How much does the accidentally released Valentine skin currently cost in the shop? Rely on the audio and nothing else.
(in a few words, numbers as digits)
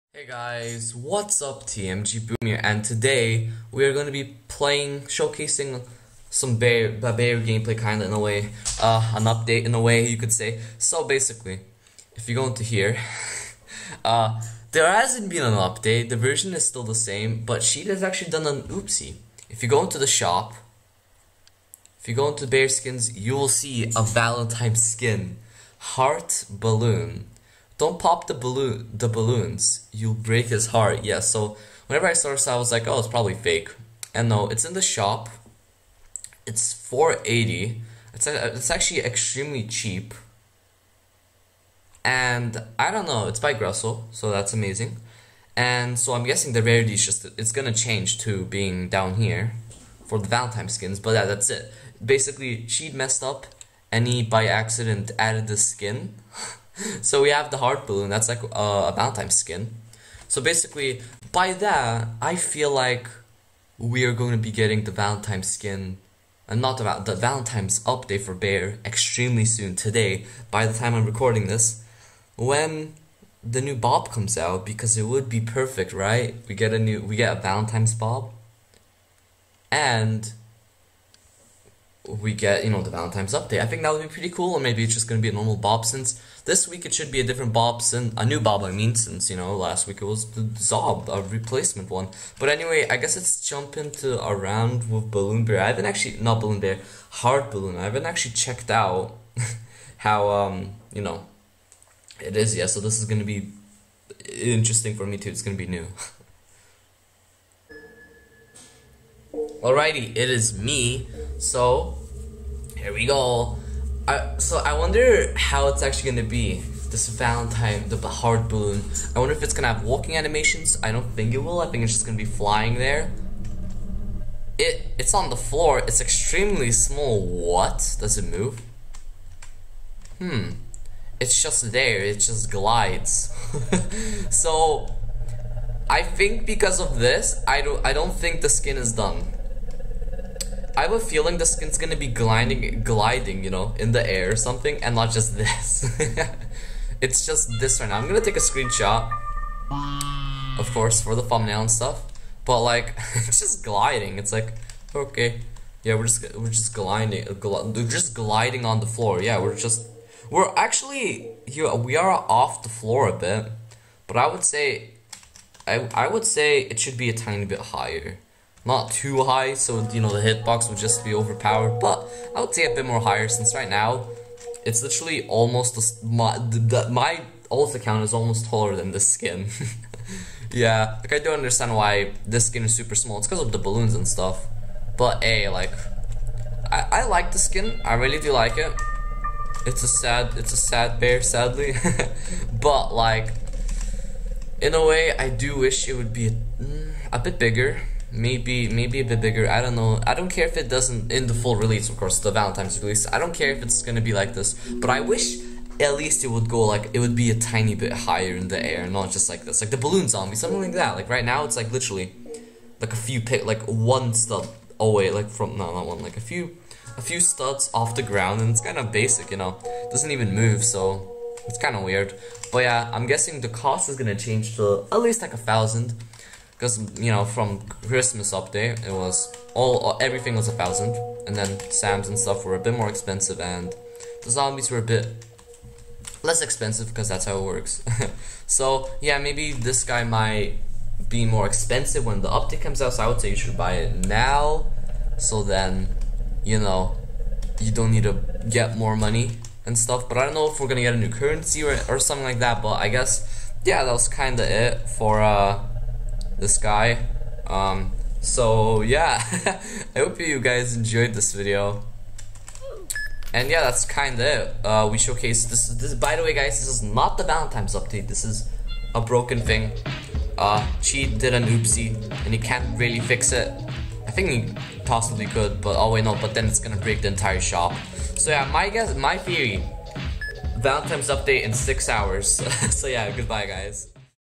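480.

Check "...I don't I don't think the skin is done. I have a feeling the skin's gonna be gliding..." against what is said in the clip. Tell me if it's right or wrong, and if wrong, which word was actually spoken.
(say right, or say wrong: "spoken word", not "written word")
right.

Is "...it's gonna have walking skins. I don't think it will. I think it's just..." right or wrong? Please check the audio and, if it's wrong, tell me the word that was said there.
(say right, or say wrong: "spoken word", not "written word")
wrong: "animations", not "skins".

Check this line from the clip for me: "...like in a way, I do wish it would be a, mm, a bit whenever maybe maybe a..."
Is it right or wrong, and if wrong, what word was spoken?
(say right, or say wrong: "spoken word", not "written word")
wrong: "bigger", not "whenever".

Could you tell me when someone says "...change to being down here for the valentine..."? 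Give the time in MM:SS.
00:47.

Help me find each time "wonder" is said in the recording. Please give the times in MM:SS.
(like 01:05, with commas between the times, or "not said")
01:54, 01:59.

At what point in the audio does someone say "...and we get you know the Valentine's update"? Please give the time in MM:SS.
01:19.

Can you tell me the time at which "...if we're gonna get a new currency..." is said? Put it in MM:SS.
04:10.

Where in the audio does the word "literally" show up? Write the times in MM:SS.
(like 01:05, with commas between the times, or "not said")
02:54, 03:31.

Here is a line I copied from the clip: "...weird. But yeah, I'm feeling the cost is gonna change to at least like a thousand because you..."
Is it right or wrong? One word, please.
wrong.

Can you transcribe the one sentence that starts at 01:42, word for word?
Yeah, so this is gonna be interesting for me too.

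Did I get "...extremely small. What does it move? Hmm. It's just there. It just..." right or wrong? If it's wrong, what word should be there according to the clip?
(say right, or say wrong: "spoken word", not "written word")
right.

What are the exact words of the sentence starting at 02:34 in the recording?
It's like, okay, yeah, we're just we're just gliding, gl we're just gliding on the floor.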